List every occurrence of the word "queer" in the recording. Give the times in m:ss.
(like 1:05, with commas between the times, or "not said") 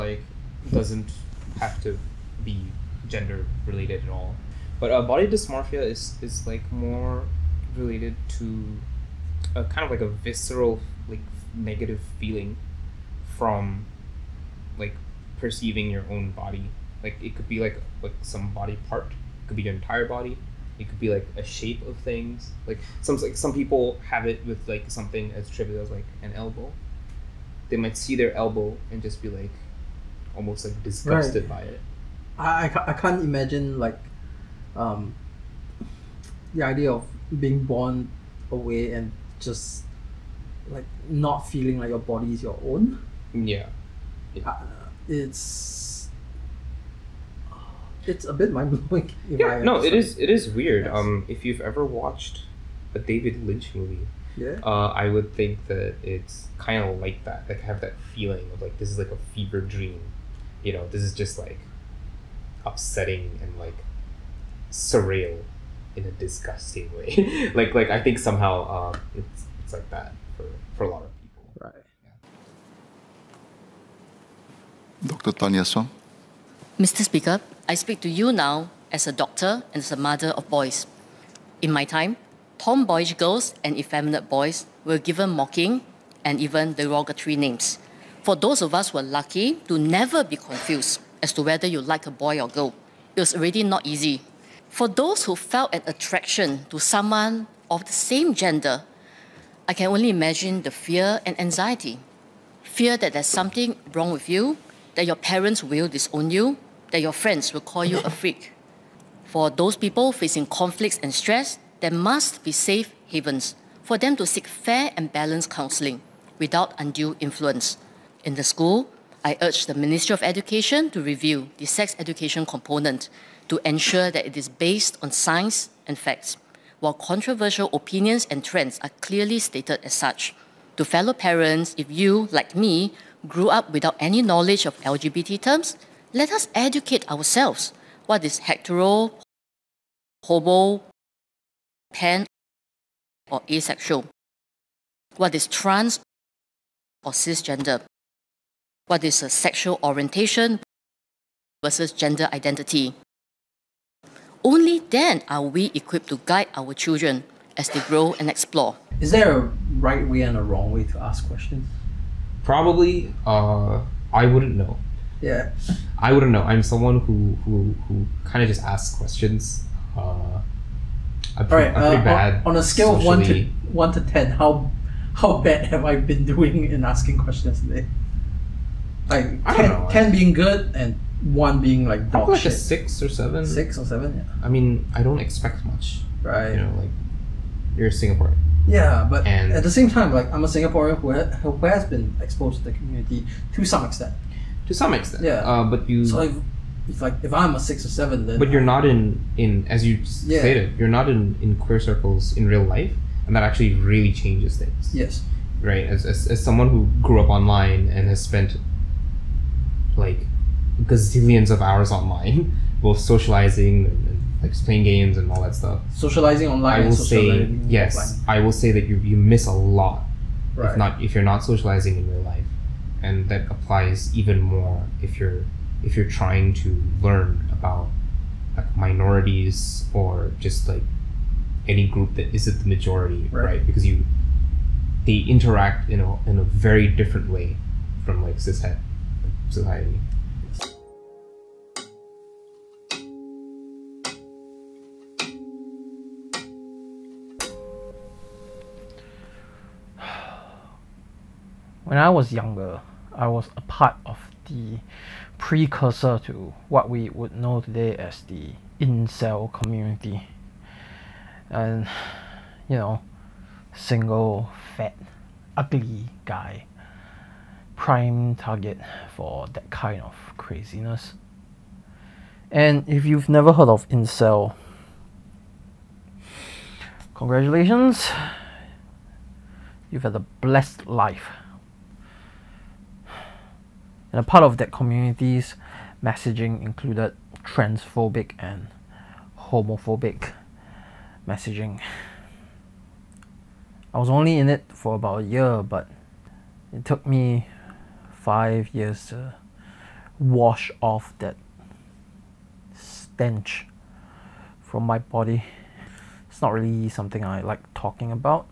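3:21.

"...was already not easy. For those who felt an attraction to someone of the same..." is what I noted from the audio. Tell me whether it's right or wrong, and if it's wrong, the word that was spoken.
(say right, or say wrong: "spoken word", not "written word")
right.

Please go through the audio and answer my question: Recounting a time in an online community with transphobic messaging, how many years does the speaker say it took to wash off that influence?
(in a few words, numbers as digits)
5.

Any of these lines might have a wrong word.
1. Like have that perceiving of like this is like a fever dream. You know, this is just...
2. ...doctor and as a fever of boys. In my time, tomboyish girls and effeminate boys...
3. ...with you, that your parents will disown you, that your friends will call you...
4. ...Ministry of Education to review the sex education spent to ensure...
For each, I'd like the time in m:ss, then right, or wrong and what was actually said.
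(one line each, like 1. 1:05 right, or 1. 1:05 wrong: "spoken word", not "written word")
1. 0:57 wrong: "feeling", not "perceiving"
2. 1:19 wrong: "mother", not "fever"
3. 1:44 right
4. 1:59 wrong: "component", not "spent".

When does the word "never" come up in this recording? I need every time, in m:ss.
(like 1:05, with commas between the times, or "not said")
1:29, 4:33.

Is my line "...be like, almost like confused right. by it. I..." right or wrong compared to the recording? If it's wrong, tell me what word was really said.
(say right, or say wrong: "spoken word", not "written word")
wrong: "disgusted", not "confused".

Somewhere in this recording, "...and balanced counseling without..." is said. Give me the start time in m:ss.
1:54.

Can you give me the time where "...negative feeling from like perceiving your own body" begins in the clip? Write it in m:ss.
0:11.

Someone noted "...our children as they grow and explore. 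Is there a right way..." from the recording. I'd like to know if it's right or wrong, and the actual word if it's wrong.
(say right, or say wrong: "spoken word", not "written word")
right.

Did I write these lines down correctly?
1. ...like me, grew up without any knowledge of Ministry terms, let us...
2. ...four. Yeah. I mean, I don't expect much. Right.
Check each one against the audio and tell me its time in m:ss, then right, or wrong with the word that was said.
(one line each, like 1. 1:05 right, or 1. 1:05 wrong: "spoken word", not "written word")
1. 2:12 wrong: "LGBT", not "Ministry"
2. 3:03 wrong: "seven", not "four".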